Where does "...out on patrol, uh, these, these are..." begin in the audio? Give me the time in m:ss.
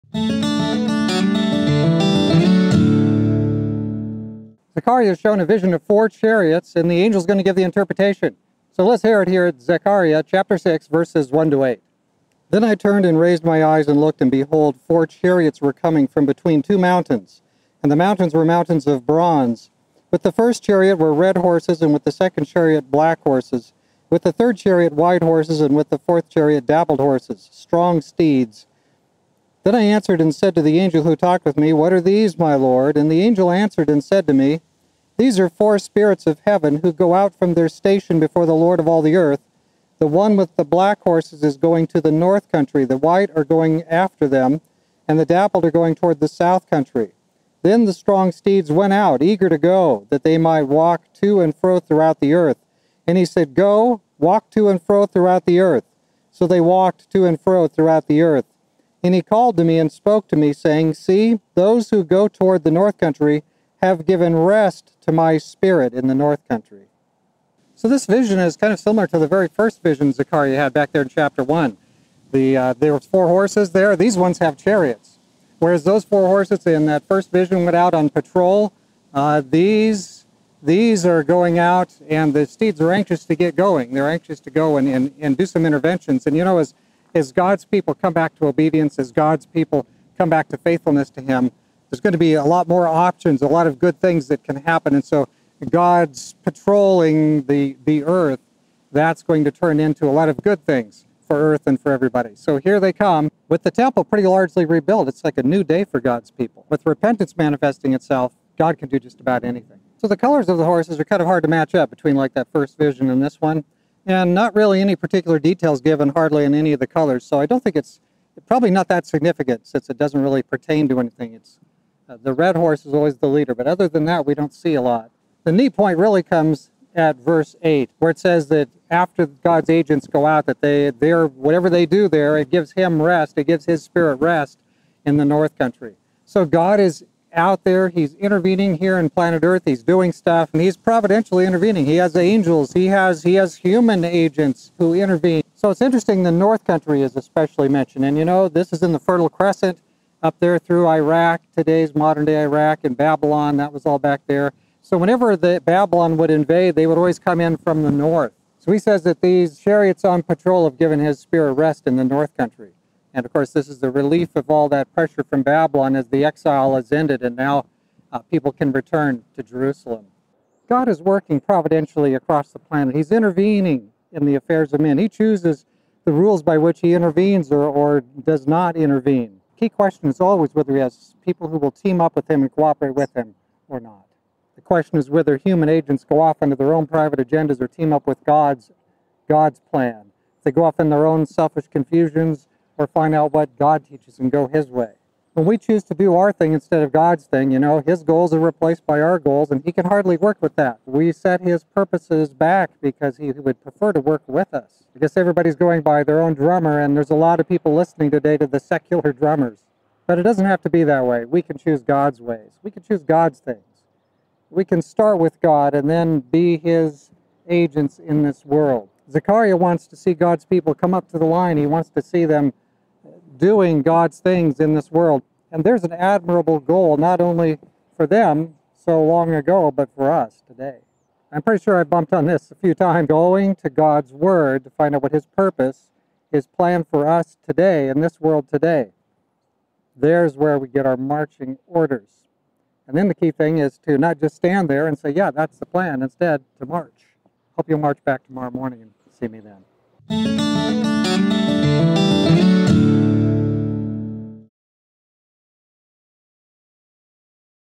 1:17.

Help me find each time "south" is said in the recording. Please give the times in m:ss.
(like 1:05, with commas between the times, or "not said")
0:46.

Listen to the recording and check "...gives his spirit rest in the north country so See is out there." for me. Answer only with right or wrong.
wrong.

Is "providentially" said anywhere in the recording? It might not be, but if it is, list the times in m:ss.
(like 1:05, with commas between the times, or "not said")
2:20, 2:51.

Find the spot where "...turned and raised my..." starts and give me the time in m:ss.
0:12.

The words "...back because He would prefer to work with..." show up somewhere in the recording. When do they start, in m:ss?
3:22.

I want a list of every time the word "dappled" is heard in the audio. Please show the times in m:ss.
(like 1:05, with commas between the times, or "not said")
0:26, 0:45.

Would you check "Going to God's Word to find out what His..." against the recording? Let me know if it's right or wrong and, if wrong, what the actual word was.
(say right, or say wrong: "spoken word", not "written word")
right.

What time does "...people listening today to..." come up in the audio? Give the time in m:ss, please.
3:27.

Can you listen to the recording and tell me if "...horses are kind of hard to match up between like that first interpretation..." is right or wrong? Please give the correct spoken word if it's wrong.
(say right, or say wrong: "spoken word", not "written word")
wrong: "vision", not "interpretation".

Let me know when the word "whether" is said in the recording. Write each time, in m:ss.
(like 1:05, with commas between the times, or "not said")
3:00, 3:05.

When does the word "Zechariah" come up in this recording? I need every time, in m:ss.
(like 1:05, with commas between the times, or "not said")
0:04, 0:09, 1:10, 3:39.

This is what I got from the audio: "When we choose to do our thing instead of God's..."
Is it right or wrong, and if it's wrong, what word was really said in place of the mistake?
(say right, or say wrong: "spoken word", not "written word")
right.